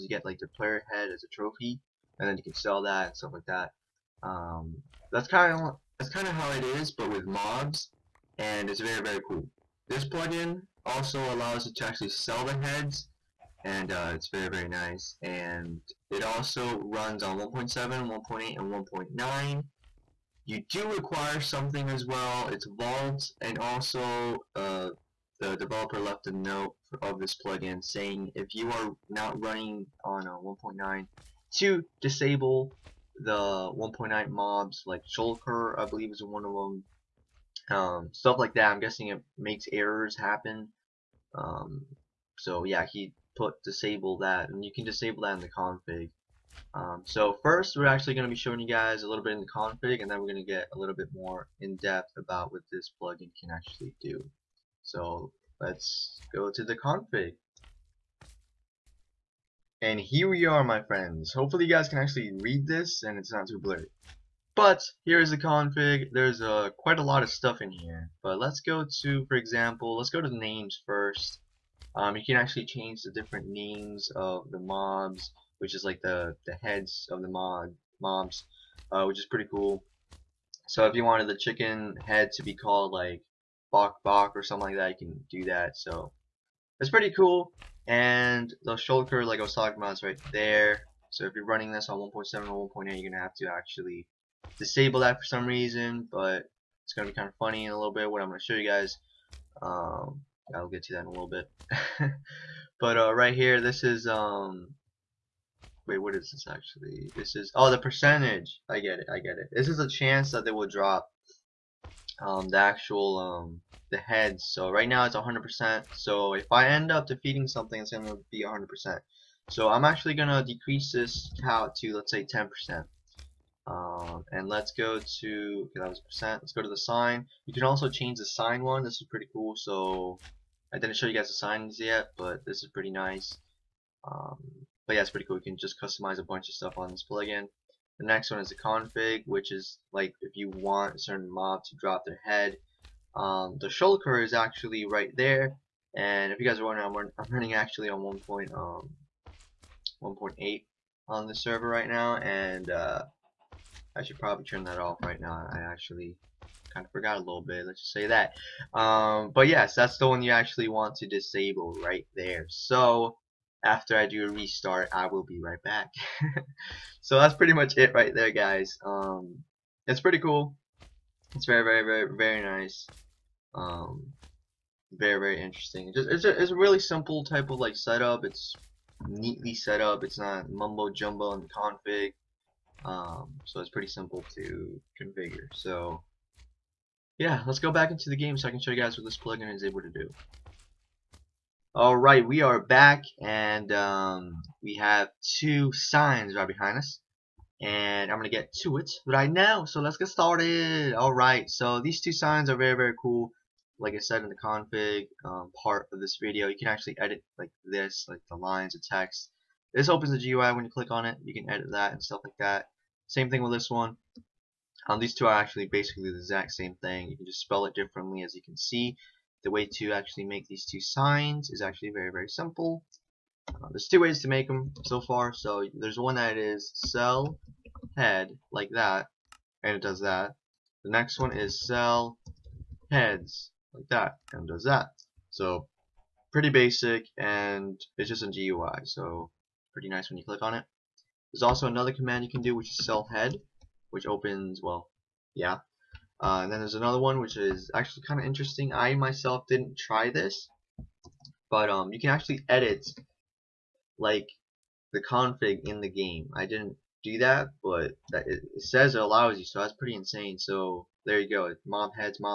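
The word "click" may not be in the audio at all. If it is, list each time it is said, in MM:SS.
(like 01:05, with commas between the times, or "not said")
03:30, 04:00.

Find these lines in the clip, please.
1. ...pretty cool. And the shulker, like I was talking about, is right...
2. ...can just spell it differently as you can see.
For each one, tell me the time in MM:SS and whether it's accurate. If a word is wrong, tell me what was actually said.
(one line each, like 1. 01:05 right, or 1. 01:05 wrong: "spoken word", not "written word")
1. 01:26 right
2. 03:37 right.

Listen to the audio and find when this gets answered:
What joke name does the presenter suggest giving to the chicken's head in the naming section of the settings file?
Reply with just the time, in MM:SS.
01:23.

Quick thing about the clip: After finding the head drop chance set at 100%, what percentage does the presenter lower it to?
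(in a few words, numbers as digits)
10%.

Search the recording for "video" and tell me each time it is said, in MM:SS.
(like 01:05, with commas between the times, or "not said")
03:26.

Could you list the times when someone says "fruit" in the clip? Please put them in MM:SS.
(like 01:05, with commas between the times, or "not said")
not said.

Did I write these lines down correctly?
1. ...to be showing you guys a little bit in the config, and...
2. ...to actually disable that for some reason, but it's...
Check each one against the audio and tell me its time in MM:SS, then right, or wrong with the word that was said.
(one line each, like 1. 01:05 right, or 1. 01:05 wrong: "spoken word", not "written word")
1. 00:48 right
2. 01:33 right.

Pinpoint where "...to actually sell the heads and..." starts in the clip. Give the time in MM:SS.
00:11.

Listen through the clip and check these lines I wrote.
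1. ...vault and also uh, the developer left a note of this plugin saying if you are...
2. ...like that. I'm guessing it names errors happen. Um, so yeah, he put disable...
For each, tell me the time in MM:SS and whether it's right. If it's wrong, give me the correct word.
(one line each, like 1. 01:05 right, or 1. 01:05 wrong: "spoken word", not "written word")
1. 00:22 right
2. 00:38 wrong: "makes", not "names".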